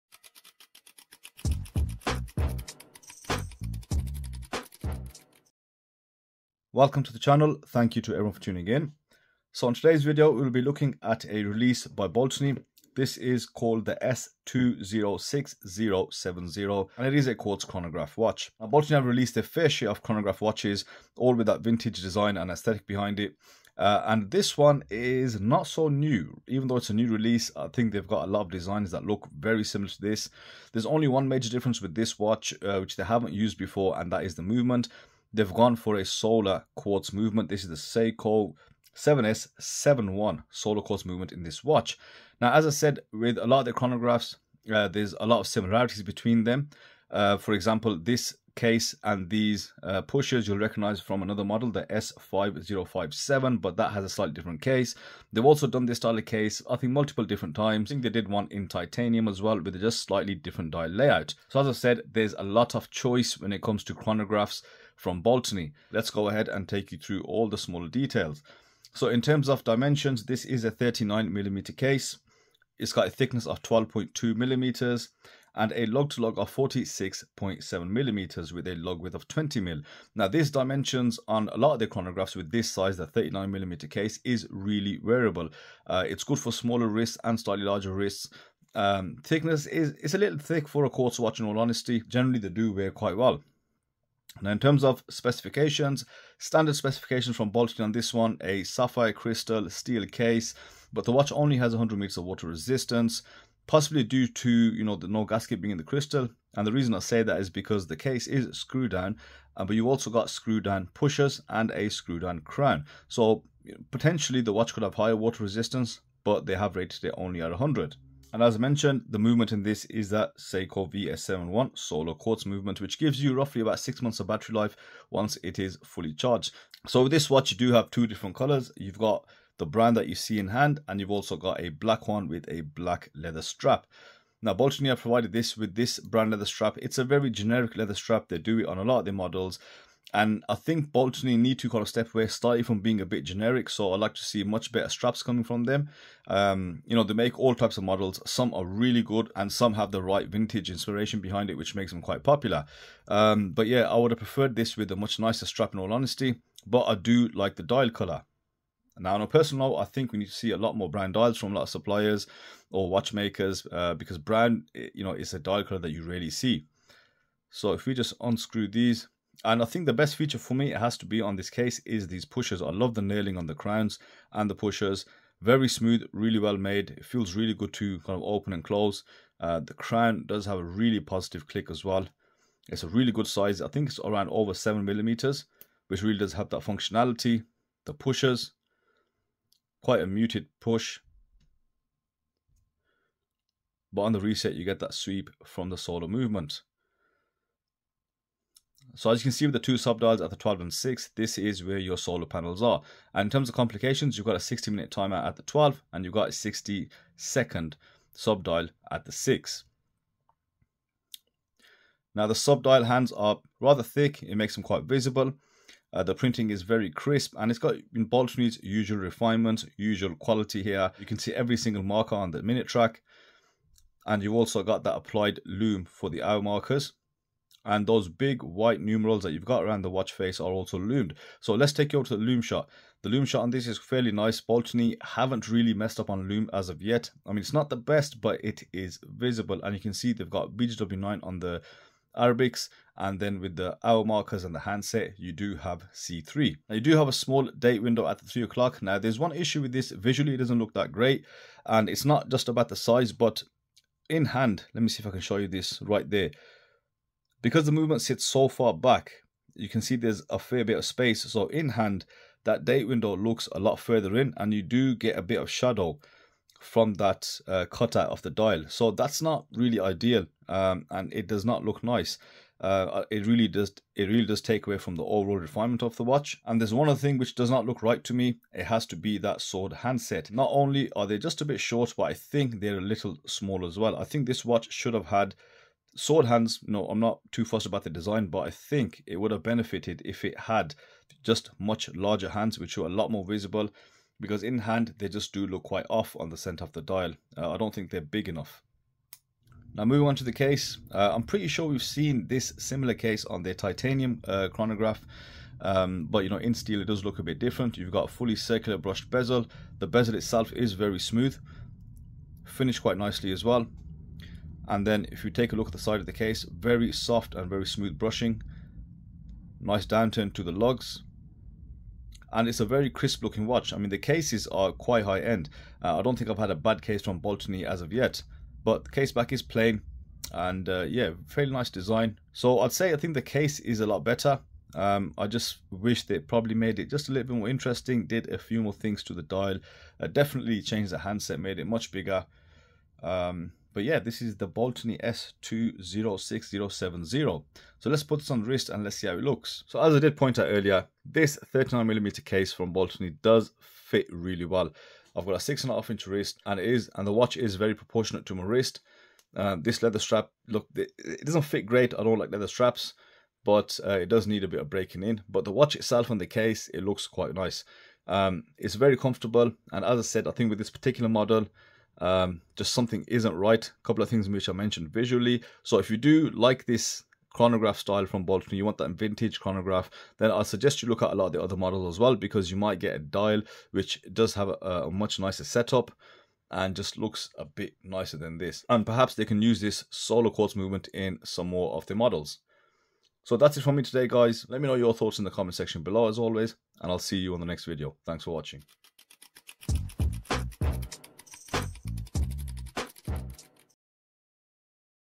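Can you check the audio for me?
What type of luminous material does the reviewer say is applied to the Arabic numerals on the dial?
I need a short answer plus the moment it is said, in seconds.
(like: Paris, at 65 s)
BGW9, at 240 s.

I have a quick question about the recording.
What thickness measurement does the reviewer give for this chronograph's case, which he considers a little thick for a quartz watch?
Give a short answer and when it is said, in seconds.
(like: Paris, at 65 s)
12.2 mm, at 73 s.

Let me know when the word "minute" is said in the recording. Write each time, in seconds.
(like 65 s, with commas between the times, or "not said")
204 s, 222 s.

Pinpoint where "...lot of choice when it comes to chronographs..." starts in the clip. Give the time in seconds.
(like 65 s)
62 s.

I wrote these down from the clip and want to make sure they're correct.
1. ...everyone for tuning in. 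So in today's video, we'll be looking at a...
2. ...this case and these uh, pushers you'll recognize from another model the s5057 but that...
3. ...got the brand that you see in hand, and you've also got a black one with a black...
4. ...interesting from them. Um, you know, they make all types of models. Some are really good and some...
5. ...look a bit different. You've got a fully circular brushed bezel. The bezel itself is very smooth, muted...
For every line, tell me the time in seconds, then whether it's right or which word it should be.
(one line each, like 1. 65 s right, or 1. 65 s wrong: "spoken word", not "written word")
1. 8 s right
2. 47 s right
3. 128 s right
4. 145 s wrong: "coming", not "interesting"
5. 307 s wrong: "finished", not "muted".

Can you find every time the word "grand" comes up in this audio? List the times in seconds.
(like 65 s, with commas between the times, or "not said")
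not said.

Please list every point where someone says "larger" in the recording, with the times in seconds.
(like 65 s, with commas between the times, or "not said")
87 s, 291 s.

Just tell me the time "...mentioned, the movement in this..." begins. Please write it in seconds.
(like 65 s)
118 s.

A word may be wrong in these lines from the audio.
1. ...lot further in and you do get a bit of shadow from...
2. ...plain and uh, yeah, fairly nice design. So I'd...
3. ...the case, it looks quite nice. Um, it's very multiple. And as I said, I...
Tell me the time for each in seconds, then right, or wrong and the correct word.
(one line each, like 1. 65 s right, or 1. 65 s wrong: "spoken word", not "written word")
1. 263 s right
2. 329 s right
3. 366 s wrong: "comfortable", not "multiple".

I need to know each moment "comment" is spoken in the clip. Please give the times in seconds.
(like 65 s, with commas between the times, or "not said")
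395 s.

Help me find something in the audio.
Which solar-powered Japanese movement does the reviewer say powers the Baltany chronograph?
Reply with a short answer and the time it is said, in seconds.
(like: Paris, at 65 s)
Seiko 7S71, at 37 s.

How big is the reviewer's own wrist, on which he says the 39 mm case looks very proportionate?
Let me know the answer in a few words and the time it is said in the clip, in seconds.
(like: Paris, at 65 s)
6.5 inches, at 355 s.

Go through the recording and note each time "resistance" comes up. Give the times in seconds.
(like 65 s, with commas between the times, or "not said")
102 s, 115 s.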